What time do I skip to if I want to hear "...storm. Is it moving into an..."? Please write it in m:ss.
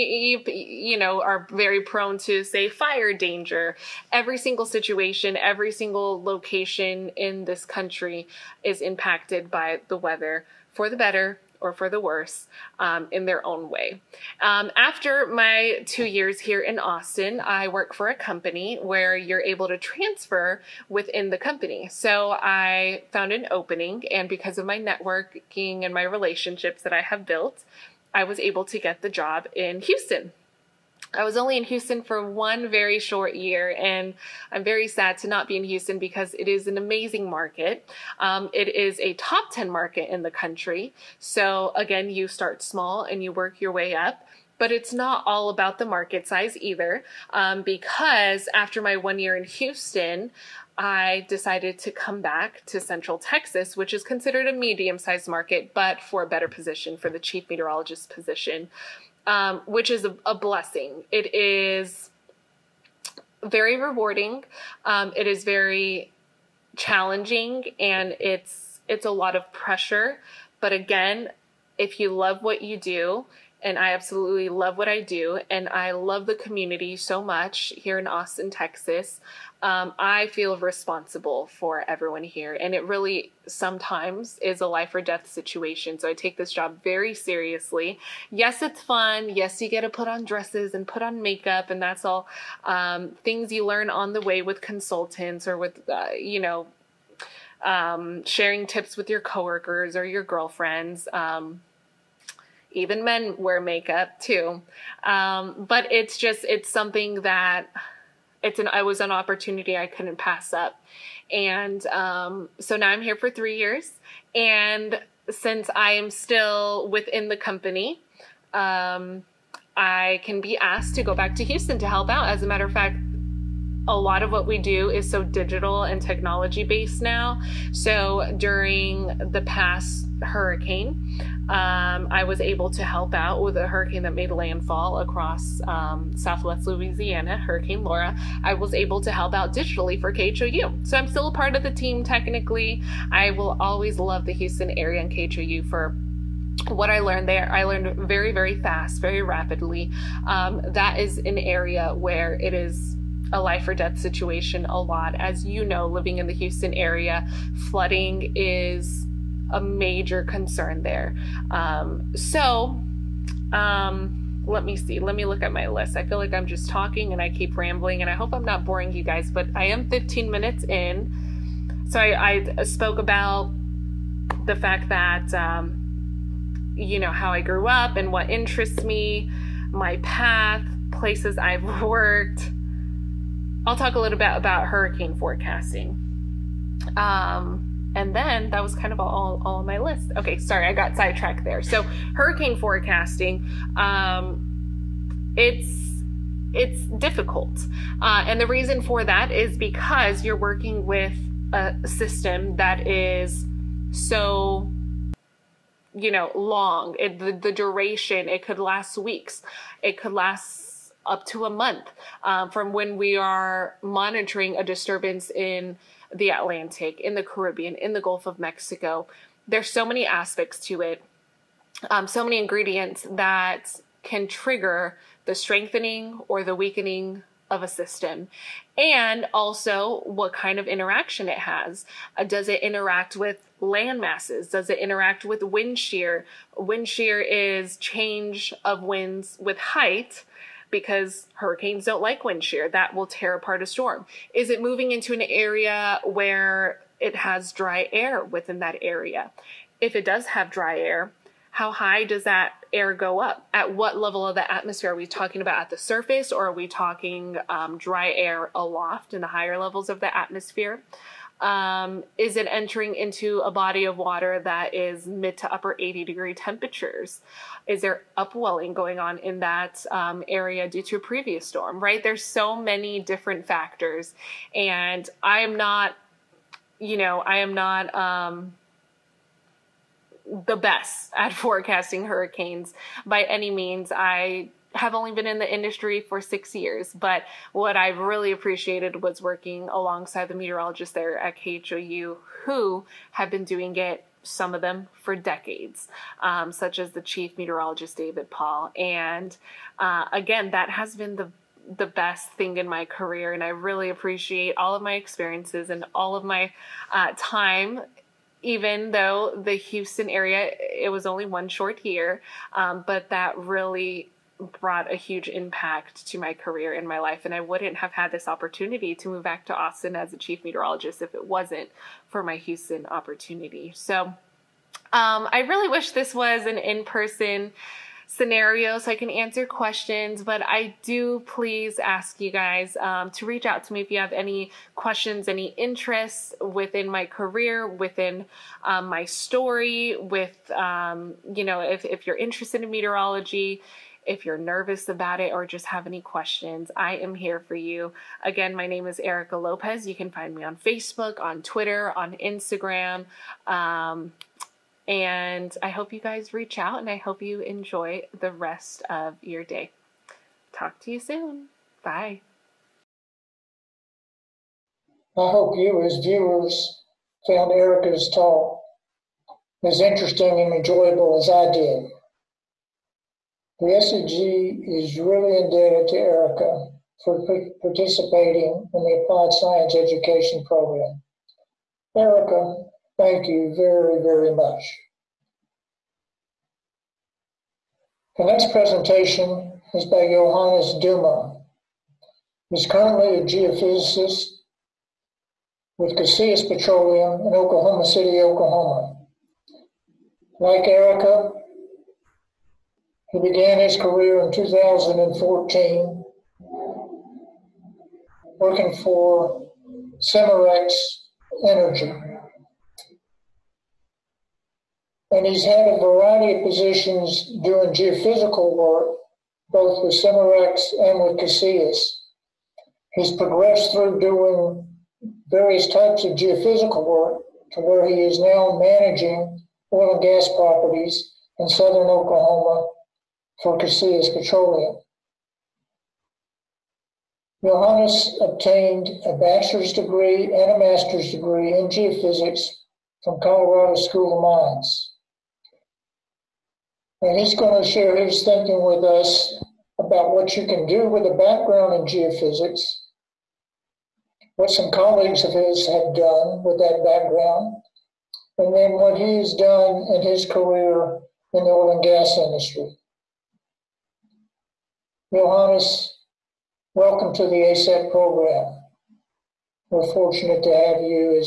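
4:03.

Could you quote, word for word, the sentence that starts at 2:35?
As you know, living in the Houston area, flooding is a major concern there.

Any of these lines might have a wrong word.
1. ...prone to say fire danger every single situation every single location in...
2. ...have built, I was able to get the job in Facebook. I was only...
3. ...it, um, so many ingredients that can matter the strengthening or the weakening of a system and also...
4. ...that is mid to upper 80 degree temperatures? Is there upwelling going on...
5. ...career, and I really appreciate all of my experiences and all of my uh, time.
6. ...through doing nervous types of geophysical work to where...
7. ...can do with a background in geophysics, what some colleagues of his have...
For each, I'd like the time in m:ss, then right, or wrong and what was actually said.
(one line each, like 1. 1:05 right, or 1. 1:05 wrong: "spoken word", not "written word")
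1. 0:01 right
2. 0:27 wrong: "Houston", not "Facebook"
3. 3:40 wrong: "trigger", not "matter"
4. 4:24 right
5. 5:02 right
6. 7:03 wrong: "various", not "nervous"
7. 7:30 right.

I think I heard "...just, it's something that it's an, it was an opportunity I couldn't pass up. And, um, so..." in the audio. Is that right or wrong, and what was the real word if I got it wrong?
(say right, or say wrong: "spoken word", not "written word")
right.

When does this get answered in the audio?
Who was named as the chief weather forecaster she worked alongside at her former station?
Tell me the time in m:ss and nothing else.
4:57.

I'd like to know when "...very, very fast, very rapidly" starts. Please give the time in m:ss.
2:27.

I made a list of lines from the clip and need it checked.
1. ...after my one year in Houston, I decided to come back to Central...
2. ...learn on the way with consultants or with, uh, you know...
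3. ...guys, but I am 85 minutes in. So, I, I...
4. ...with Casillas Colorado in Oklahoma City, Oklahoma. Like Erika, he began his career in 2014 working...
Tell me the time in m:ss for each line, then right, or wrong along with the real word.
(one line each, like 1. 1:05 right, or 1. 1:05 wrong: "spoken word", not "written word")
1. 0:48 right
2. 1:33 right
3. 2:49 wrong: "15", not "85"
4. 6:35 wrong: "Petroleum", not "Colorado".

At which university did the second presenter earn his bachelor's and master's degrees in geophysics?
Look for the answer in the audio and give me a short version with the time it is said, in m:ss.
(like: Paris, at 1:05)
Colorado School of Mines, at 7:23.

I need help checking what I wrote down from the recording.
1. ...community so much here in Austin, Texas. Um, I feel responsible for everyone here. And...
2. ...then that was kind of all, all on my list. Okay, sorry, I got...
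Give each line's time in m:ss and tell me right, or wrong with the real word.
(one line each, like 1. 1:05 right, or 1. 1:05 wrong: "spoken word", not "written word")
1. 1:16 right
2. 3:08 right.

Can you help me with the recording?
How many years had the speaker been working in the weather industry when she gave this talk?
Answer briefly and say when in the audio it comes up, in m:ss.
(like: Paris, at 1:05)
6, at 4:46.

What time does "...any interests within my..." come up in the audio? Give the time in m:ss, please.
5:35.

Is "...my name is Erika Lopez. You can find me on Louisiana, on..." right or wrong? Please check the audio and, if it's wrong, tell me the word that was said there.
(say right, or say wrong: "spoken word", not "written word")
wrong: "Facebook", not "Louisiana".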